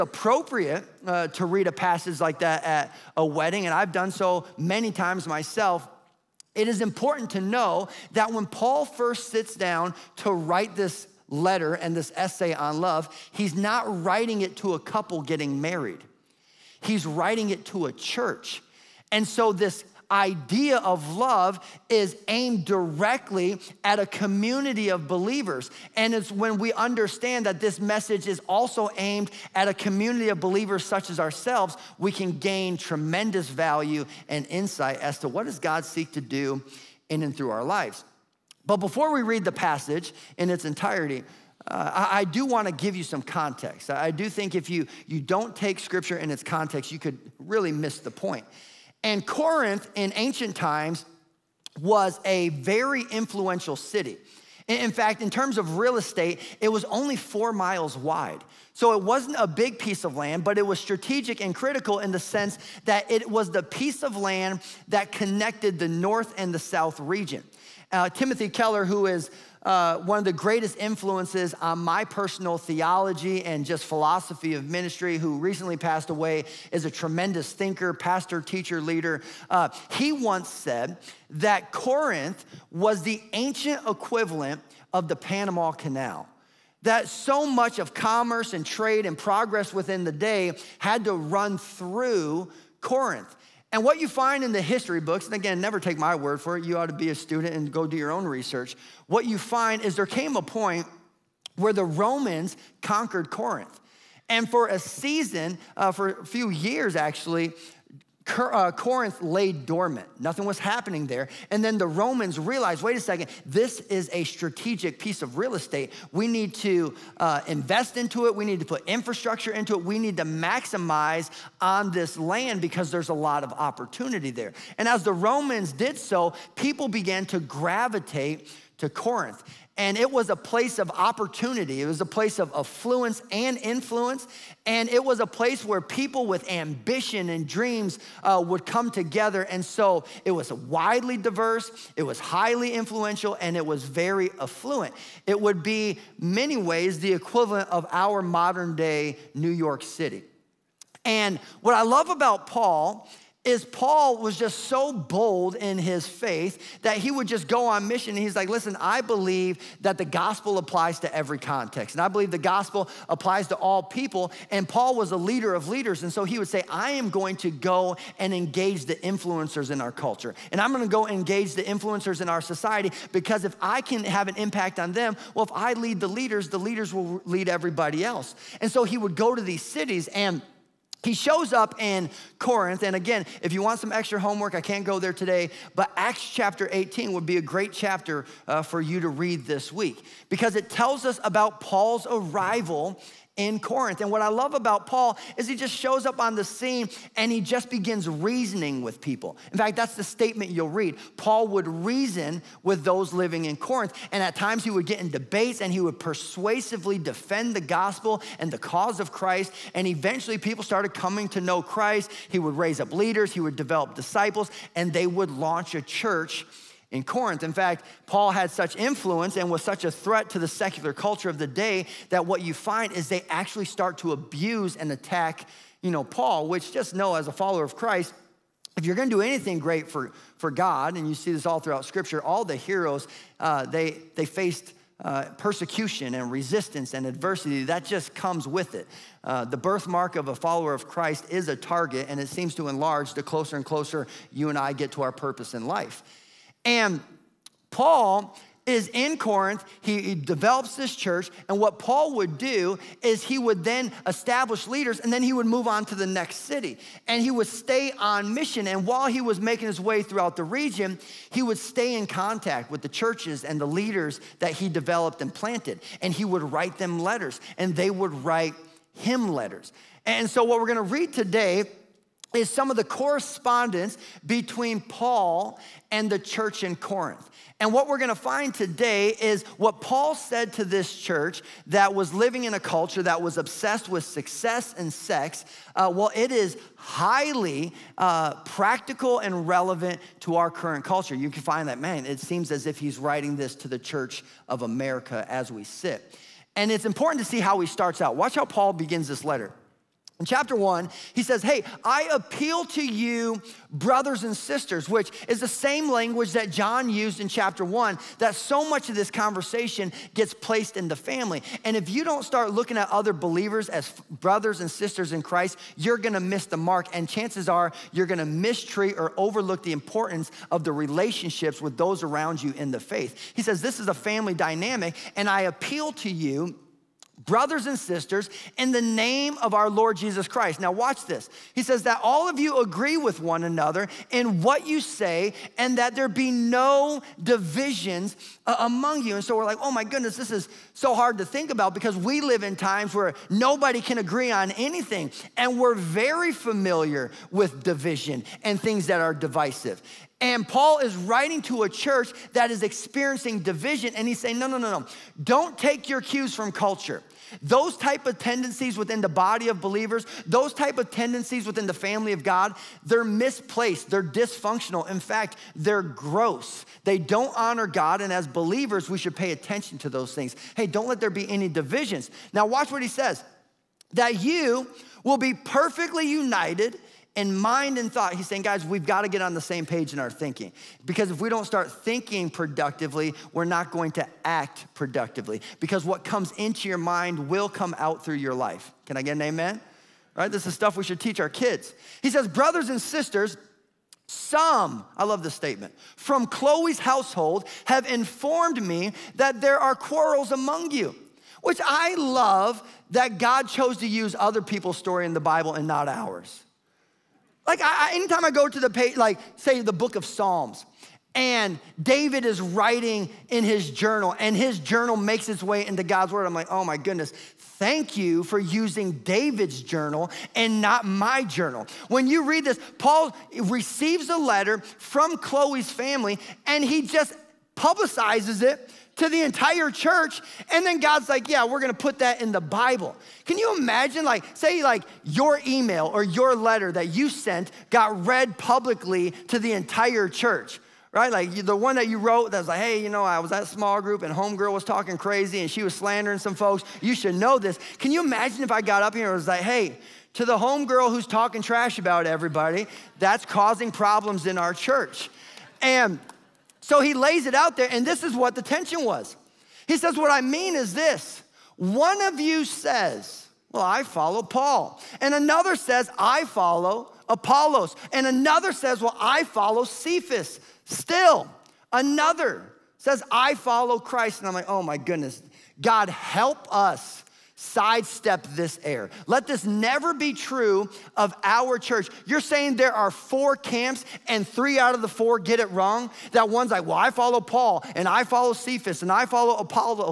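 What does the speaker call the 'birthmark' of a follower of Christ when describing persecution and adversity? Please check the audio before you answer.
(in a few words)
A target.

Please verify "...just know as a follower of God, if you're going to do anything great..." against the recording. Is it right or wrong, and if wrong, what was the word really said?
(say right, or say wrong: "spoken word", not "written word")
wrong: "Christ", not "God".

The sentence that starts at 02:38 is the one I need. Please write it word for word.
And he's like, listen, I believe that the gospel applies to every context.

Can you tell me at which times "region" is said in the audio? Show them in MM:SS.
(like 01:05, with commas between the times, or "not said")
01:06, 04:20.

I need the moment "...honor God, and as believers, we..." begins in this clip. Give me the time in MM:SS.
06:07.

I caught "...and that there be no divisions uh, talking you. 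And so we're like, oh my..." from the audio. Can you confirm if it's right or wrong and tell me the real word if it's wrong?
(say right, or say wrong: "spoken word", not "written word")
wrong: "among", not "talking".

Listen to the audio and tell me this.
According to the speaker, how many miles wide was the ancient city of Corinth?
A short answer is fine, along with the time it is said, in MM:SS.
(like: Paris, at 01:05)
4, at 00:57.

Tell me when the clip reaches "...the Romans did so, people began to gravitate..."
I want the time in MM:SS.
02:05.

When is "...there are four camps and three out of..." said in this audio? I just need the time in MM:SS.
08:02.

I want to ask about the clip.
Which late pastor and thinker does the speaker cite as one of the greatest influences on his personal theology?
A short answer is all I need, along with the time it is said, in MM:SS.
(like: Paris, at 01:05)
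Timothy Keller, at 01:08.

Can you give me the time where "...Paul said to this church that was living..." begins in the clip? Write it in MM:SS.
04:39.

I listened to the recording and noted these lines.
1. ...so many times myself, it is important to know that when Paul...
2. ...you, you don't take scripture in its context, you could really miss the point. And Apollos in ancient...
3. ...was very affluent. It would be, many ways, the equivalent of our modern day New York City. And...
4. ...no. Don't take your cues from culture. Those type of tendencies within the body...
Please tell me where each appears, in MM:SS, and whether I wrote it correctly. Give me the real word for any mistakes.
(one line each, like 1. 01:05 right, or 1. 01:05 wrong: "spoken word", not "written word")
1. 00:04 right
2. 00:44 wrong: "Corinth", not "Apollos"
3. 02:23 right
4. 05:54 right.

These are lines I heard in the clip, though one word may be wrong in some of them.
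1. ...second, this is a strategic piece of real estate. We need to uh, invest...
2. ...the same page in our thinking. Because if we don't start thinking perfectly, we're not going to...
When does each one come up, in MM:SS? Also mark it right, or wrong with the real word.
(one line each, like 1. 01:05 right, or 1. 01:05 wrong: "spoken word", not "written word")
1. 01:52 right
2. 06:19 wrong: "productively", not "perfectly".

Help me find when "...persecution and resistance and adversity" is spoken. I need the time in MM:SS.
03:55.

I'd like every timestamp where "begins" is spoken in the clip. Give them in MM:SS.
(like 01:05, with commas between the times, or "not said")
03:17, 04:58.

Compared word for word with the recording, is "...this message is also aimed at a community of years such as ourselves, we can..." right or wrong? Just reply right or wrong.
wrong.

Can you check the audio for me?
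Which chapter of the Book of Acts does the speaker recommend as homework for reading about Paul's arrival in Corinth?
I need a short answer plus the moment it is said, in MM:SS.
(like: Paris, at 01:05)
Acts chapter 18, at 03:05.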